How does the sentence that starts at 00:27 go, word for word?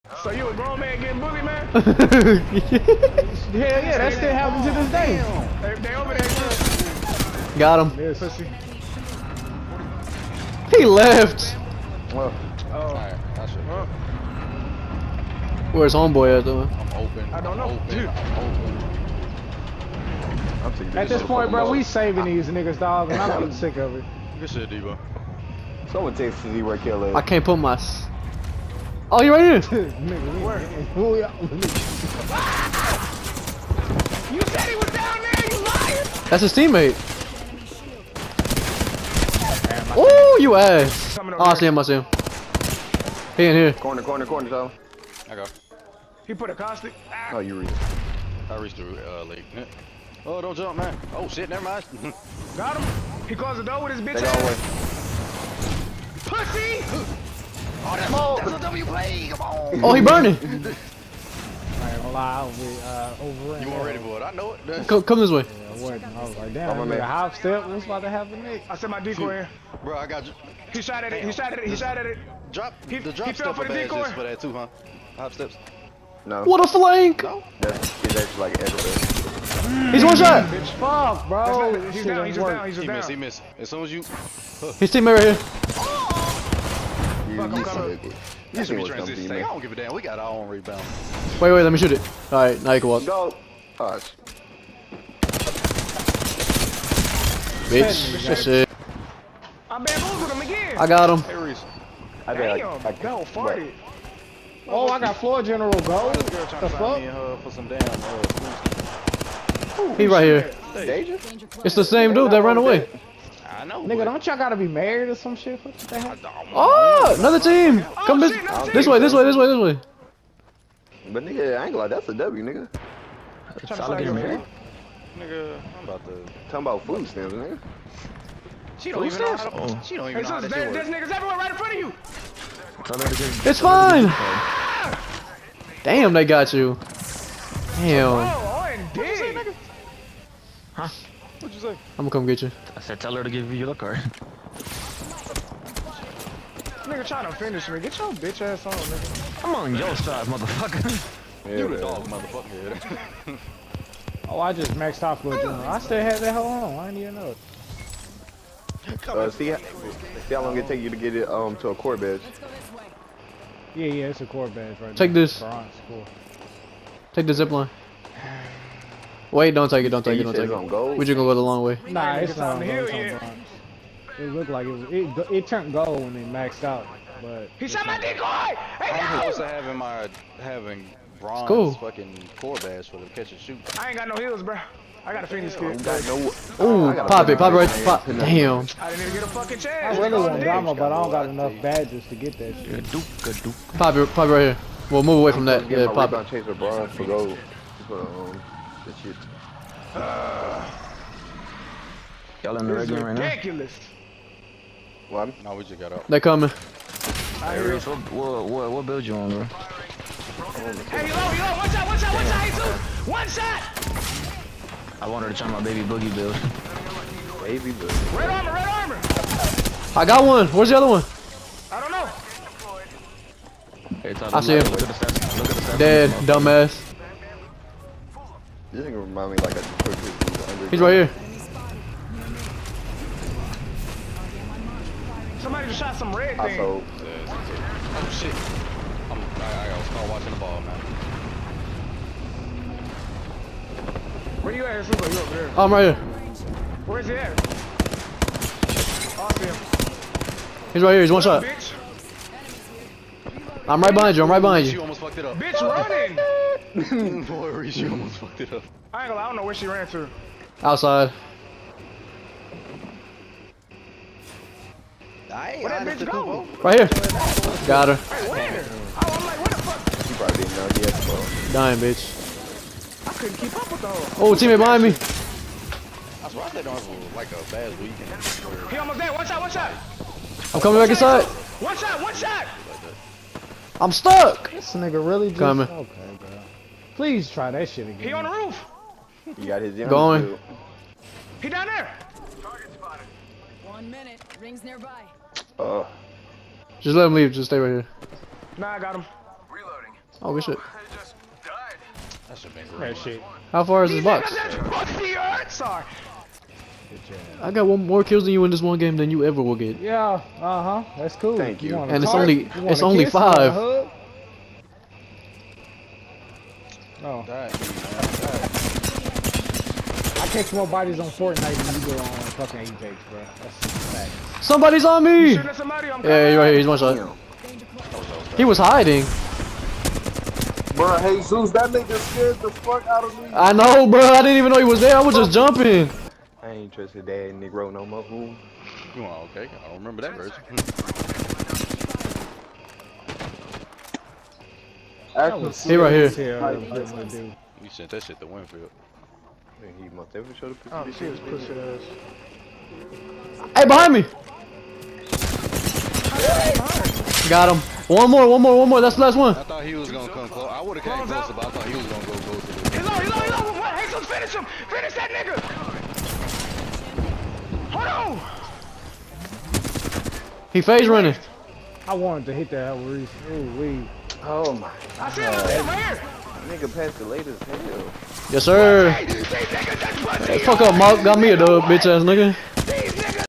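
I can't put my Oh, you're right here!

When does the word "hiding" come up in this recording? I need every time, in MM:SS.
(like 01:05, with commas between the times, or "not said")
05:28.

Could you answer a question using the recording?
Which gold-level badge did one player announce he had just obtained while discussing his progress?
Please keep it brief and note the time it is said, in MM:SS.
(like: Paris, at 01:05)
floor general, at 01:45.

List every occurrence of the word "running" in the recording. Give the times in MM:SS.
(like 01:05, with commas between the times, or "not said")
04:15, 06:10.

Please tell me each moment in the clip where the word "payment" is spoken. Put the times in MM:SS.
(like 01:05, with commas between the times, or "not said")
not said.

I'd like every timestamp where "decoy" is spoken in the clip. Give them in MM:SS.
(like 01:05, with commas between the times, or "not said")
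01:08, 01:13, 02:57.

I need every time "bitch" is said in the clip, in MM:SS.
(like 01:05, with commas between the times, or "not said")
00:53, 01:20, 01:37, 02:28, 04:14, 04:25, 04:31, 06:21.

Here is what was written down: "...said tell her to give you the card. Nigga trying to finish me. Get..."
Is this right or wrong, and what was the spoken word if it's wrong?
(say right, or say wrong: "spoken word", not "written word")
right.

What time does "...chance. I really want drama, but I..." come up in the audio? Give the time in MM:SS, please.
03:09.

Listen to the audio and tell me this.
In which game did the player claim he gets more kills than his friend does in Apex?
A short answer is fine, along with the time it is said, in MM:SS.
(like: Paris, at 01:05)
Fortnite, at 05:21.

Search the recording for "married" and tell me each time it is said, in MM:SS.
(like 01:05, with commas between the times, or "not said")
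01:54, 02:04.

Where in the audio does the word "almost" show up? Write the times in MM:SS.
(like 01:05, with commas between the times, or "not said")
04:17, 04:38.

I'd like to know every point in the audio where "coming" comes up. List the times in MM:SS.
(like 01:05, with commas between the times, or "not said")
01:27, 03:26, 04:40, 04:45.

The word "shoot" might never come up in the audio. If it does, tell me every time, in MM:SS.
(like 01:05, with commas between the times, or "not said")
01:31, 03:03.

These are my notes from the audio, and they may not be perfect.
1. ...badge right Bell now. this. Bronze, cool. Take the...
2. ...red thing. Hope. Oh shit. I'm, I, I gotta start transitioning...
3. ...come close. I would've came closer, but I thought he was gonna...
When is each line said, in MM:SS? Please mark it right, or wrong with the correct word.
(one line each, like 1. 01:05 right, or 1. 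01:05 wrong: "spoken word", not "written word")
1. 02:44 wrong: "Take", not "Bell"
2. 03:56 wrong: "watching", not "transitioning"
3. 06:00 right.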